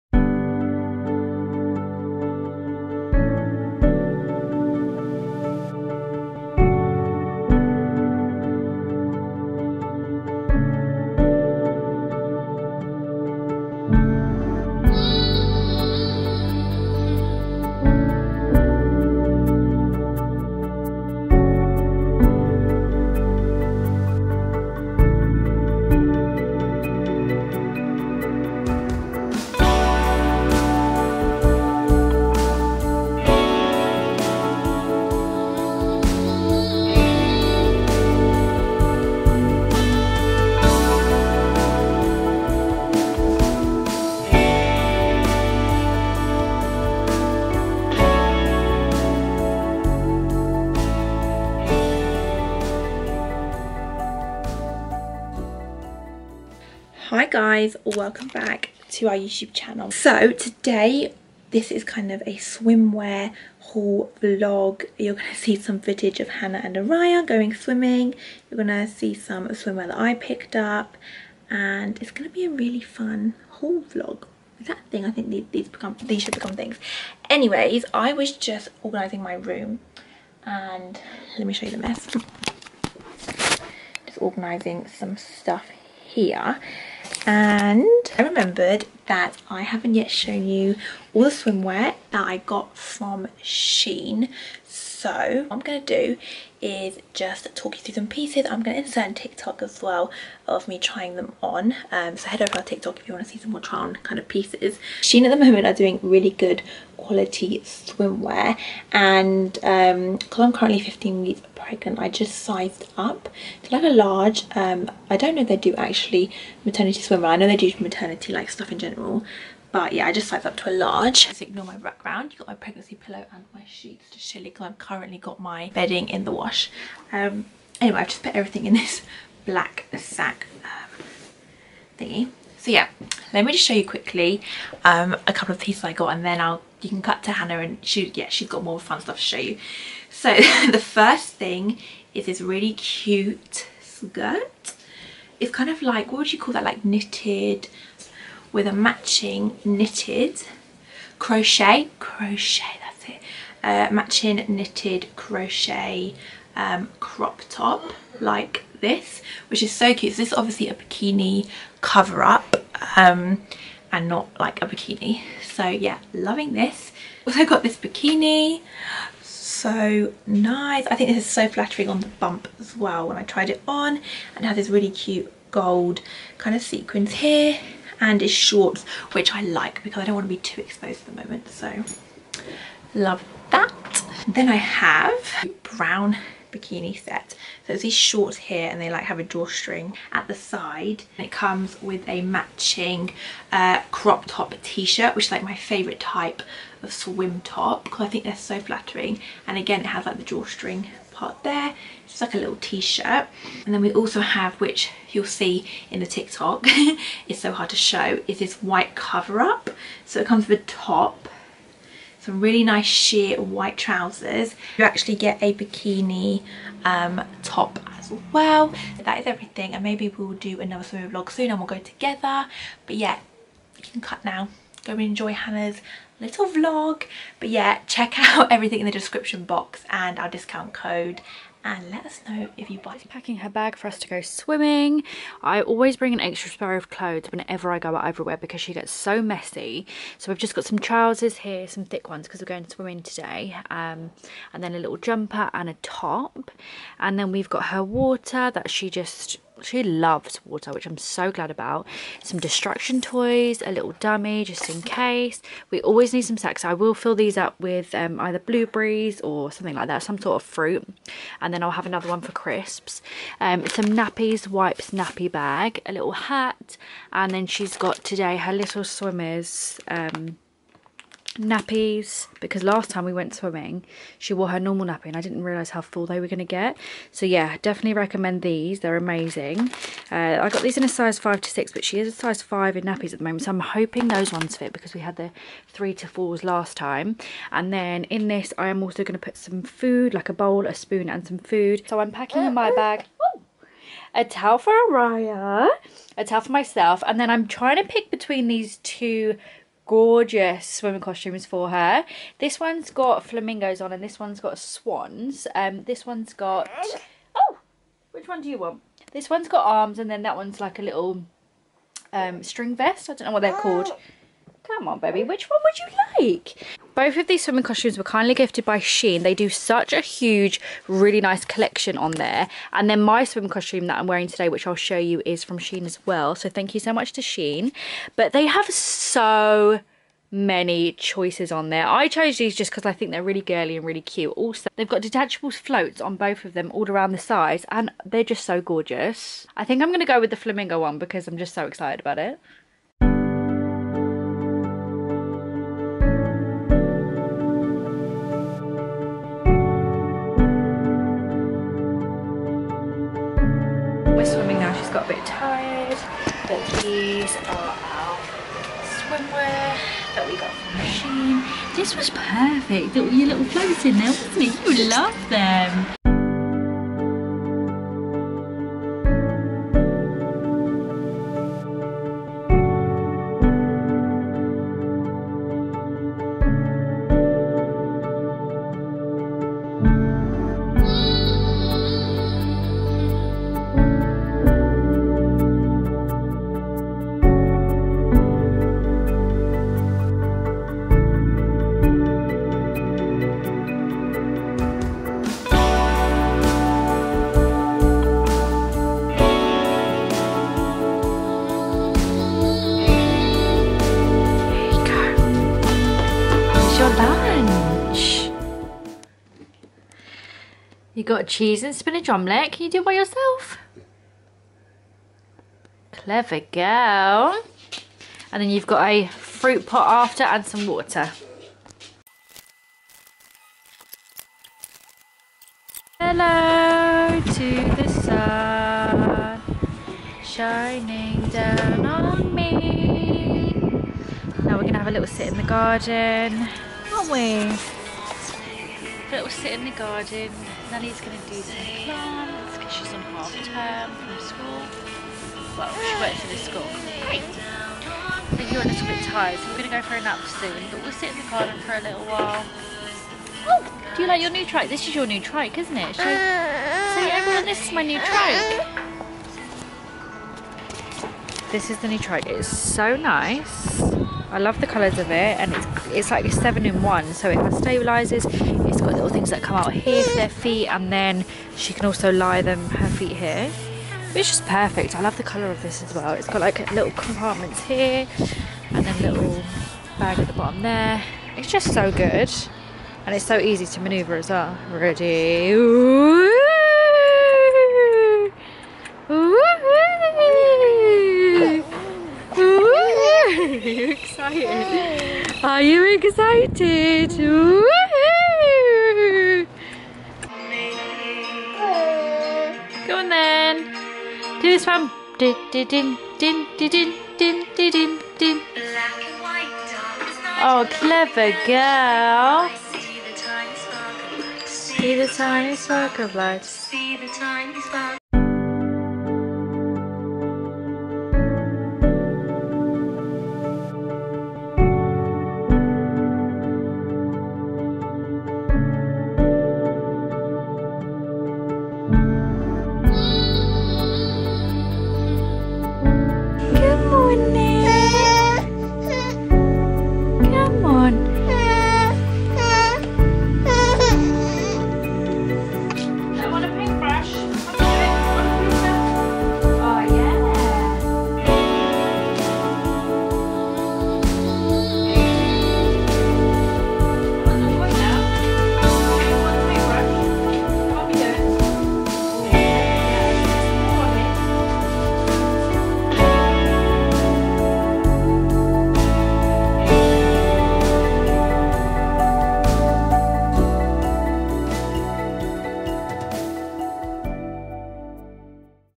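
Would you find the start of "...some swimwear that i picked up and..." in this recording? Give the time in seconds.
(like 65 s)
69 s.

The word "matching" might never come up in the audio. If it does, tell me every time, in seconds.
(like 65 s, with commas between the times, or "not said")
148 s, 153 s, 192 s.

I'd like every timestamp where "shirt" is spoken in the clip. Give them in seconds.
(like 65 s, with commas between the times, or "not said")
194 s, 202 s.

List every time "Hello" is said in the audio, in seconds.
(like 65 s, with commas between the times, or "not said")
425 s.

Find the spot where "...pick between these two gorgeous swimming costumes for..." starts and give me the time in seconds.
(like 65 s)
297 s.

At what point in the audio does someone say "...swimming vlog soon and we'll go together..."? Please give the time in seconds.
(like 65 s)
220 s.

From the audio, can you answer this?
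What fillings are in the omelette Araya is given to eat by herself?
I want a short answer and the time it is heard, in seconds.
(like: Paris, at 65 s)
cheese and spinach, at 411 s.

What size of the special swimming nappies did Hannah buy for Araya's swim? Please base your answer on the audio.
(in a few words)
5 to 6.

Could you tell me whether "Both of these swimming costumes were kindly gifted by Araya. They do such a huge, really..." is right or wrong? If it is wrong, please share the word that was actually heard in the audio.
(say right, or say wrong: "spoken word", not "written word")
wrong: "Shein", not "Araya".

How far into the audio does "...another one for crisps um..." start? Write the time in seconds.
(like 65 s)
261 s.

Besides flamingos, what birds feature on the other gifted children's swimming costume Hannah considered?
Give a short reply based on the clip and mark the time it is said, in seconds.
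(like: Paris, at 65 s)
swans, at 304 s.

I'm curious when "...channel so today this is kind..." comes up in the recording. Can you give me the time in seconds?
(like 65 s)
59 s.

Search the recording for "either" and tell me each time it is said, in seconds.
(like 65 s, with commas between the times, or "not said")
258 s.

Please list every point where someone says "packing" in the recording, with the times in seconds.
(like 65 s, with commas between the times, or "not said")
233 s, 292 s.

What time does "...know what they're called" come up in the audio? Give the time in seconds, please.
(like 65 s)
313 s.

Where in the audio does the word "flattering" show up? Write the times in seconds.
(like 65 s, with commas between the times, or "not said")
171 s, 198 s.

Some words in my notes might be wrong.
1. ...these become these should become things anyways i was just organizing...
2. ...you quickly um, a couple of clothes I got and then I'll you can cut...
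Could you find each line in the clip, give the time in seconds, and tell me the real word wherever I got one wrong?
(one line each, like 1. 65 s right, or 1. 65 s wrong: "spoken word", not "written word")
1. 75 s right
2. 133 s wrong: "pieces", not "clothes".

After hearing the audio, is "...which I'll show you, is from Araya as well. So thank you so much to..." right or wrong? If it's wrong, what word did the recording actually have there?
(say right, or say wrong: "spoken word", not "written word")
wrong: "Shein", not "Araya".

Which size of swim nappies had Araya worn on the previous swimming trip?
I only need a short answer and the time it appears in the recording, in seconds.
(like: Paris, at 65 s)
3 to 4, at 285 s.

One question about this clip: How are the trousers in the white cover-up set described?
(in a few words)
sheer white.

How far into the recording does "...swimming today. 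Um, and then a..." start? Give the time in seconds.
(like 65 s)
242 s.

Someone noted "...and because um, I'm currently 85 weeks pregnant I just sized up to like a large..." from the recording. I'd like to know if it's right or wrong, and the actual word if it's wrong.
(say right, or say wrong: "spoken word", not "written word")
wrong: "15", not "85".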